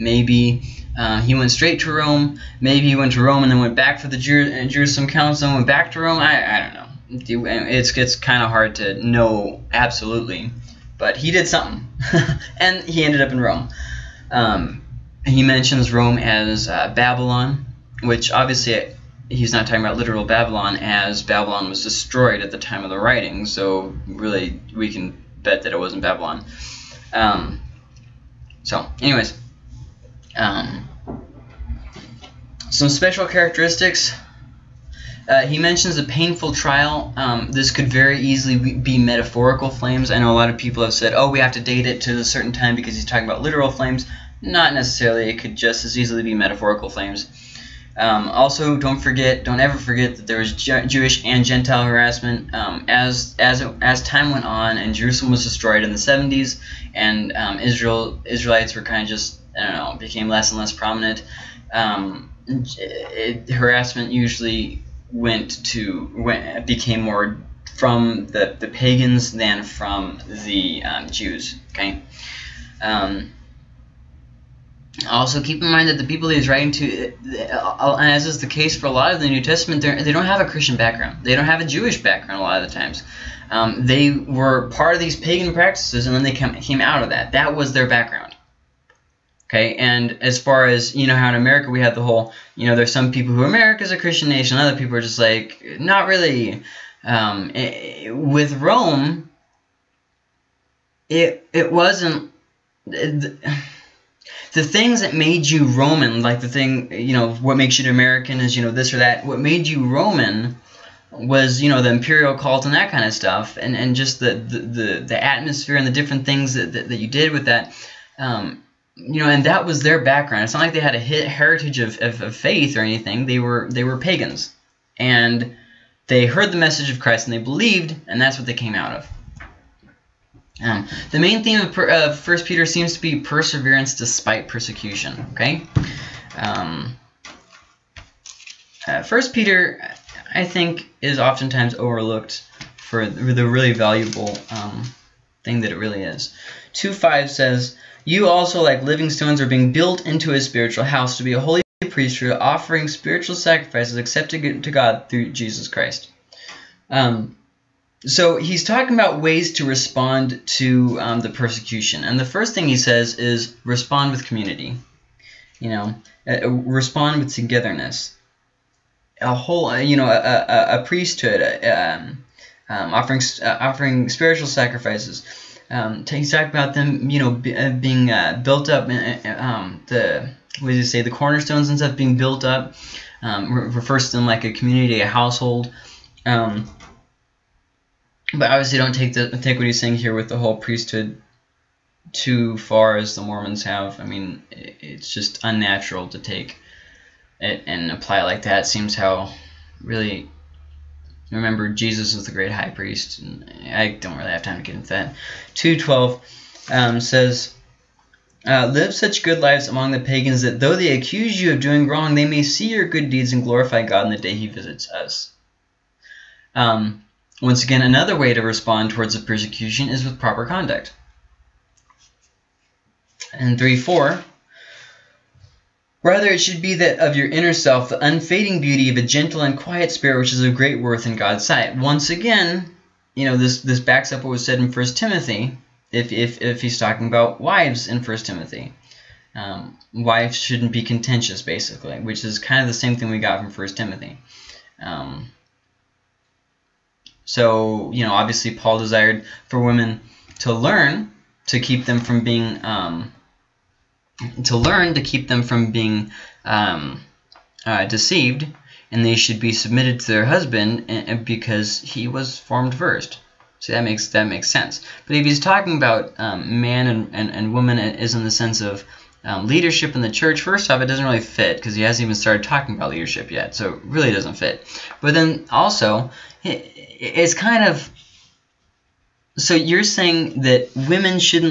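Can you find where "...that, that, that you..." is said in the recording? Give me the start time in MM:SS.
01:56.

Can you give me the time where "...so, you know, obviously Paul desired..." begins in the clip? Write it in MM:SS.
04:07.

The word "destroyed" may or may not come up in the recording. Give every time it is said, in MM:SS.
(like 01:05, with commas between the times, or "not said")
00:21, 00:55.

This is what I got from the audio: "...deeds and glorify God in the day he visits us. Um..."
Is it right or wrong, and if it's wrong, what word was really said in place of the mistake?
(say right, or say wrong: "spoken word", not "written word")
right.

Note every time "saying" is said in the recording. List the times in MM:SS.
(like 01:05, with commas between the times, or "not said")
03:09, 04:39.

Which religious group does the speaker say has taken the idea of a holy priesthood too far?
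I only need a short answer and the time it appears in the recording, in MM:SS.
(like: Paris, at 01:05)
The Mormons, at 03:13.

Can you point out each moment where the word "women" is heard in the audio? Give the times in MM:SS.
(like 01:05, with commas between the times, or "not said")
04:09, 04:40.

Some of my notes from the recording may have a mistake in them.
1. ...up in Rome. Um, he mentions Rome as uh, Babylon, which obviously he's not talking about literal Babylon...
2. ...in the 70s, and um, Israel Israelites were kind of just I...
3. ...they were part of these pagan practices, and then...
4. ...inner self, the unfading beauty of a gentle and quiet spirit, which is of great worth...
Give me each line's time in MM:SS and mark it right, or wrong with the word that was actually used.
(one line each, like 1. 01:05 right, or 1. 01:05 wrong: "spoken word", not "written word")
1. 00:13 right
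2. 00:55 right
3. 01:23 right
4. 03:47 right.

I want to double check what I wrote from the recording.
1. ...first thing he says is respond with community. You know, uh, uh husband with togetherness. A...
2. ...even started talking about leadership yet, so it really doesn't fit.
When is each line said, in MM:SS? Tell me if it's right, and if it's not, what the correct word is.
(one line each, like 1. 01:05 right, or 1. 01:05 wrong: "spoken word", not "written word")
1. 02:42 wrong: "respond", not "husband"
2. 04:32 right.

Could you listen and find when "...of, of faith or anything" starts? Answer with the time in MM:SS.
02:02.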